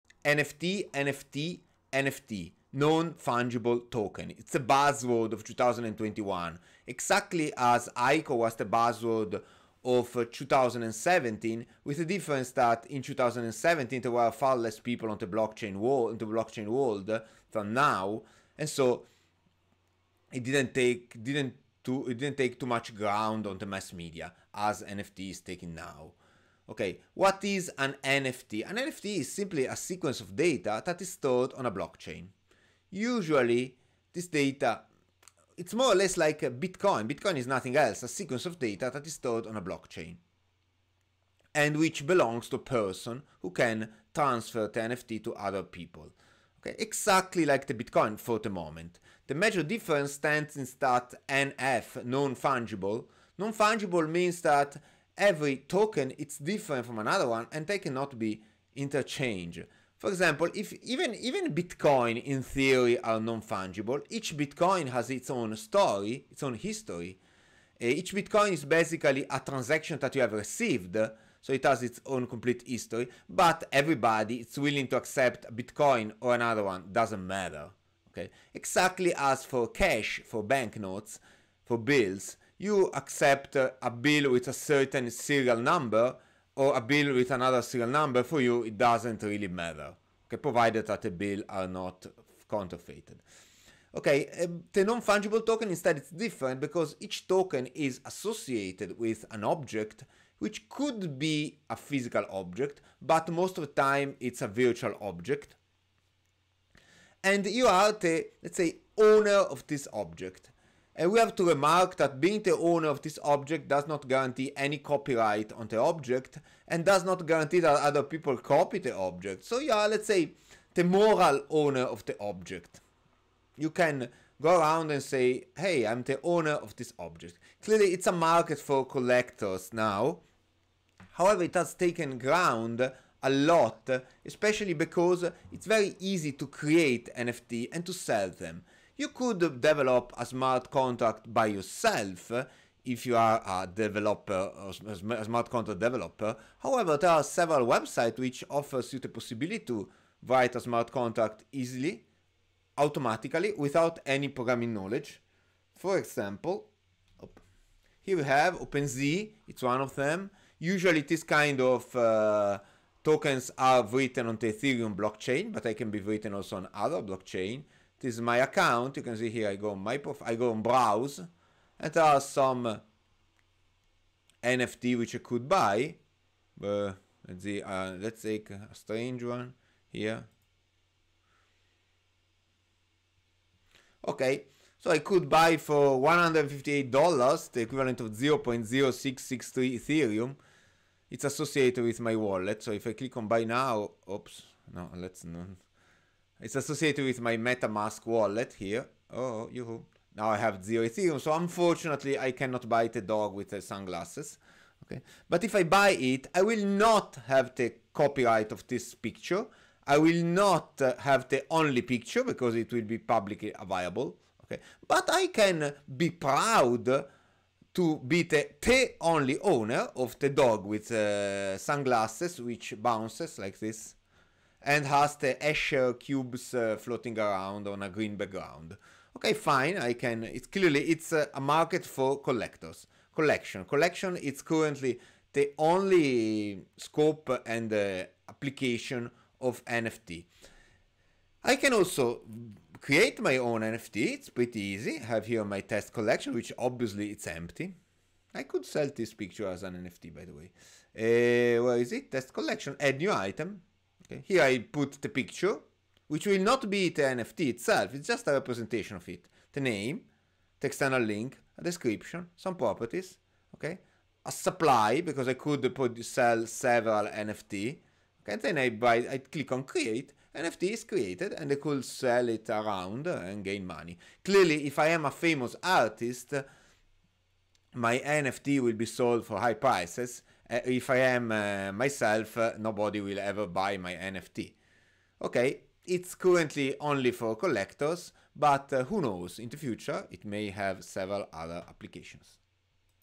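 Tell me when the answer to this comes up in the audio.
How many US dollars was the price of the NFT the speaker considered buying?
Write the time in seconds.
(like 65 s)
186 s.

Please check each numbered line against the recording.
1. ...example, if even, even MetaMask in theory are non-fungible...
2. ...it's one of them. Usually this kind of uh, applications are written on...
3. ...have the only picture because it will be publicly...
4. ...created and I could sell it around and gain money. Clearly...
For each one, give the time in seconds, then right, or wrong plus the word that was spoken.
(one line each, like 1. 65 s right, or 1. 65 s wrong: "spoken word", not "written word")
1. 60 s wrong: "Bitcoin", not "MetaMask"
2. 159 s wrong: "tokens", not "applications"
3. 210 s right
4. 270 s right.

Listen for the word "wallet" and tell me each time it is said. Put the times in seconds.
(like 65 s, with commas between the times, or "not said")
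192 s, 198 s.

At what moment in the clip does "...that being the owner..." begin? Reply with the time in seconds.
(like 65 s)
111 s.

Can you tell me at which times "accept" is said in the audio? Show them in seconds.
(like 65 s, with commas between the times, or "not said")
74 s, 82 s.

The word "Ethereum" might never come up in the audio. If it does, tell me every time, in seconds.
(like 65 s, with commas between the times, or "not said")
164 s, 189 s, 200 s.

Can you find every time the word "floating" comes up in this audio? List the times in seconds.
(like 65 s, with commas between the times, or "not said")
226 s.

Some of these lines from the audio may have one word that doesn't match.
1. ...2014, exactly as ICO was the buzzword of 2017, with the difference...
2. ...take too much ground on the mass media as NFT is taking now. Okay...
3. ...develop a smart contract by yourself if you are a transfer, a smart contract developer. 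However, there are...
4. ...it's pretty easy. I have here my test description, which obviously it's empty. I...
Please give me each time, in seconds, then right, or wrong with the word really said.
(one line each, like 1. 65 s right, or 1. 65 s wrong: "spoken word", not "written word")
1. 5 s wrong: "2021", not "2014"
2. 22 s right
3. 139 s wrong: "developer", not "transfer"
4. 244 s wrong: "collection", not "description".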